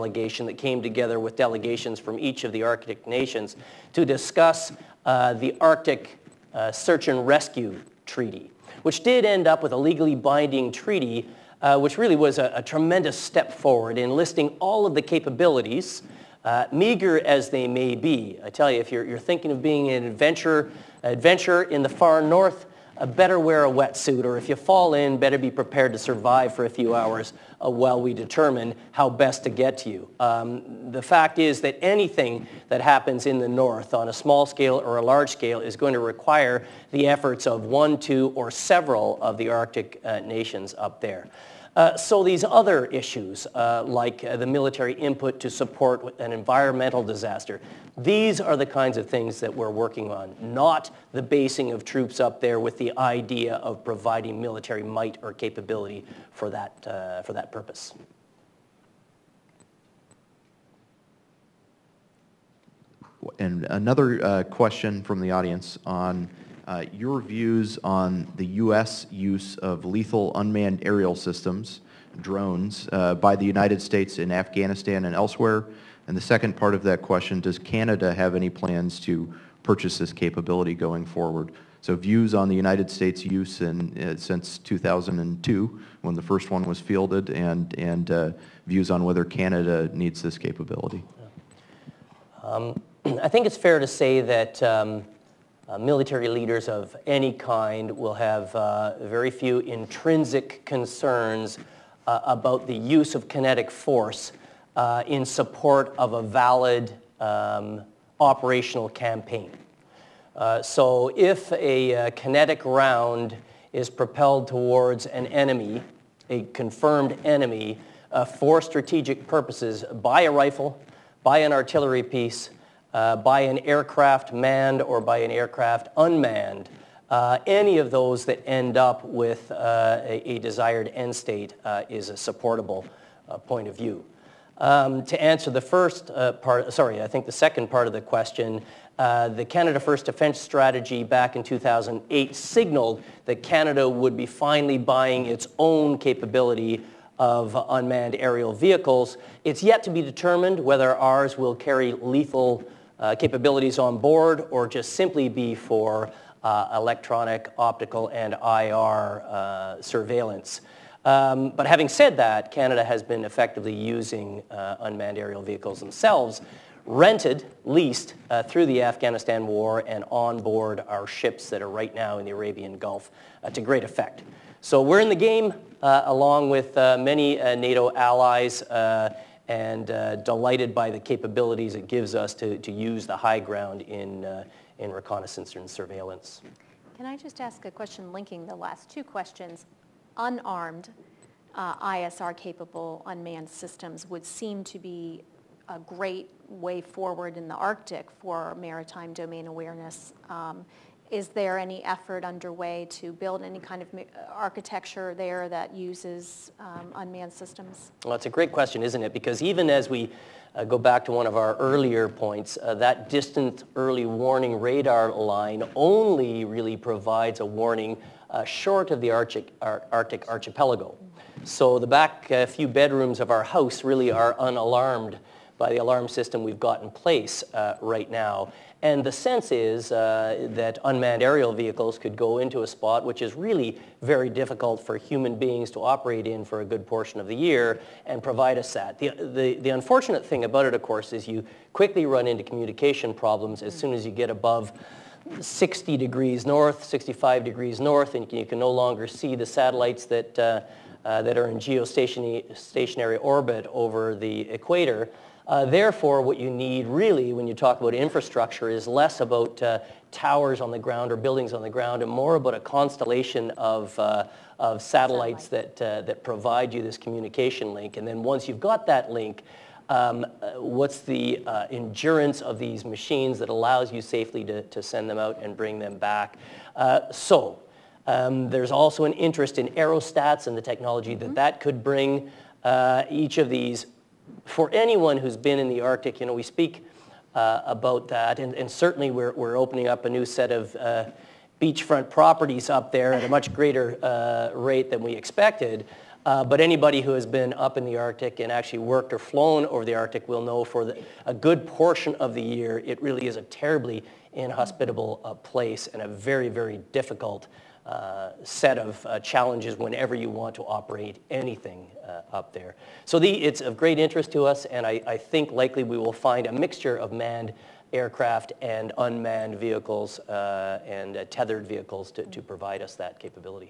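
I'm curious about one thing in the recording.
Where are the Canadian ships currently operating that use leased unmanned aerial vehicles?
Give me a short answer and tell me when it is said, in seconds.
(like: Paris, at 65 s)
Arabian Gulf, at 172 s.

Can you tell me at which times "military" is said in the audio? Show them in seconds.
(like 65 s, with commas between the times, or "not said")
44 s, 54 s, 95 s.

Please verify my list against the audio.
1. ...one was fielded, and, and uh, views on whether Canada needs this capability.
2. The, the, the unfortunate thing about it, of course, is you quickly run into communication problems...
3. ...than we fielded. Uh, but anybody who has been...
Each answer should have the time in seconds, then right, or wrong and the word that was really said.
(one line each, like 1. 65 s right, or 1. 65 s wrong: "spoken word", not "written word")
1. 86 s right
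2. 238 s right
3. 294 s wrong: "expected", not "fielded".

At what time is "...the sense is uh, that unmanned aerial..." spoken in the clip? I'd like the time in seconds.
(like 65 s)
229 s.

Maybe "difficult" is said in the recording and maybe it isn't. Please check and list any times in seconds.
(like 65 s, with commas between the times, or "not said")
234 s, 306 s.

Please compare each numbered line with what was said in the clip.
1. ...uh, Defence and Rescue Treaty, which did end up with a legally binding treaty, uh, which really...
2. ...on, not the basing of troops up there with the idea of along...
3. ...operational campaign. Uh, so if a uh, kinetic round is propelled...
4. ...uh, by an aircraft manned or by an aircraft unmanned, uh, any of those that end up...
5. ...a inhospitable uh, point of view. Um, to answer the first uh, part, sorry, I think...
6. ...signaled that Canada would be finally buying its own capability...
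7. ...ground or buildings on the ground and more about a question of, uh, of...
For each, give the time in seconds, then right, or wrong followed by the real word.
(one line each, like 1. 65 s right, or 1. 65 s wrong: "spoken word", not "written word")
1. 6 s wrong: "Search", not "Defence"
2. 50 s wrong: "providing", not "along"
3. 108 s right
4. 122 s right
5. 132 s wrong: "supportable", not "inhospitable"
6. 142 s right
7. 260 s wrong: "constellation", not "question".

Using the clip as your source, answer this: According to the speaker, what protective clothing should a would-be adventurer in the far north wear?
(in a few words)
a wetsuit.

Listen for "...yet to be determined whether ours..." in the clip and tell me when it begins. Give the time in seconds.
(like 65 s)
149 s.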